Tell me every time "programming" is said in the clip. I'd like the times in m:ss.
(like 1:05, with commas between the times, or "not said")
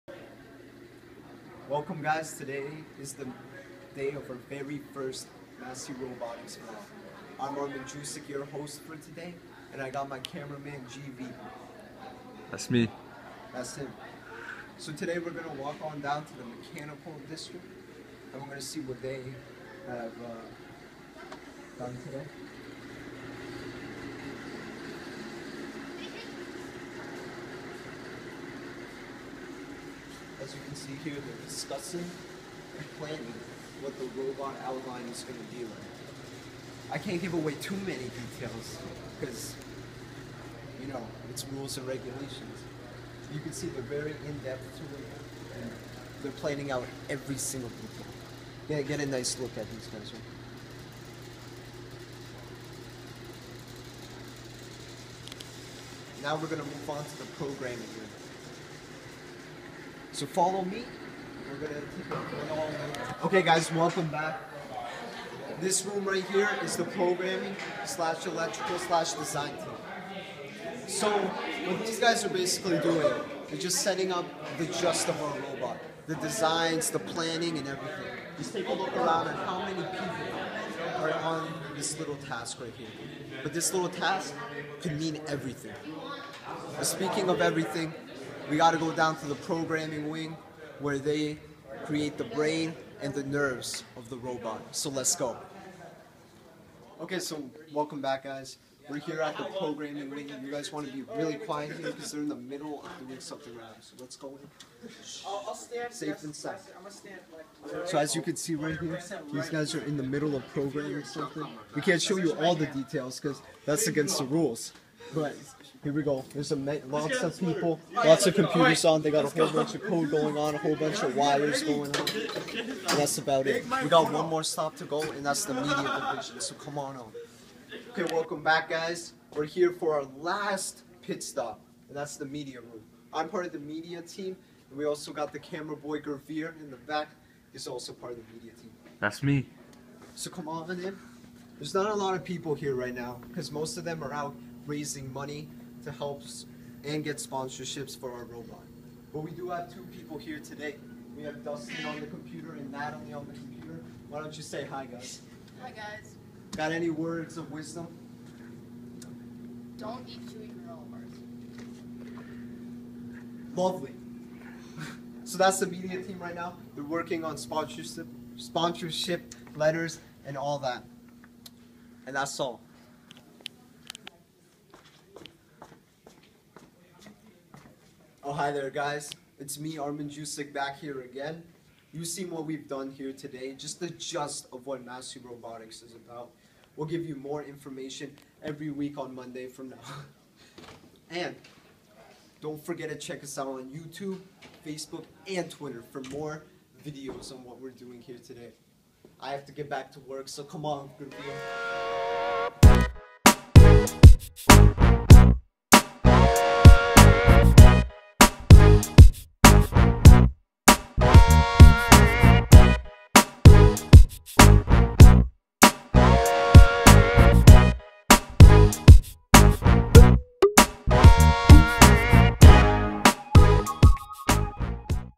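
0:57, 1:06, 1:29, 1:39, 1:50.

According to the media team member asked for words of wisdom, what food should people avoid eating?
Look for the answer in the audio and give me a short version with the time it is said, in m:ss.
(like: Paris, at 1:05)
Chewy bars, at 2:40.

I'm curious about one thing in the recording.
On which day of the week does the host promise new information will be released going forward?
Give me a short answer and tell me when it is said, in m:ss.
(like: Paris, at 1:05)
Monday, at 3:09.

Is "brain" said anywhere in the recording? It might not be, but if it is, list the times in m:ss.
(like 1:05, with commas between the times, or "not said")
1:32.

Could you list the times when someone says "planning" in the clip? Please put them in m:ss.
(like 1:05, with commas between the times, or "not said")
0:32, 0:46, 1:16.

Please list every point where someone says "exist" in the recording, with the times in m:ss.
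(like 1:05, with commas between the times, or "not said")
not said.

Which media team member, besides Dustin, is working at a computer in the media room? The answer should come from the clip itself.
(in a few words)
Natalie.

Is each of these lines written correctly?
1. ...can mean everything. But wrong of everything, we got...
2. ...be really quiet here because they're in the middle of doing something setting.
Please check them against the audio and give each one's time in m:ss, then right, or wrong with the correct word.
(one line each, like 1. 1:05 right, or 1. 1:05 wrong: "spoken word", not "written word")
1. 1:24 wrong: "speaking", not "wrong"
2. 1:40 wrong: "wrong", not "setting".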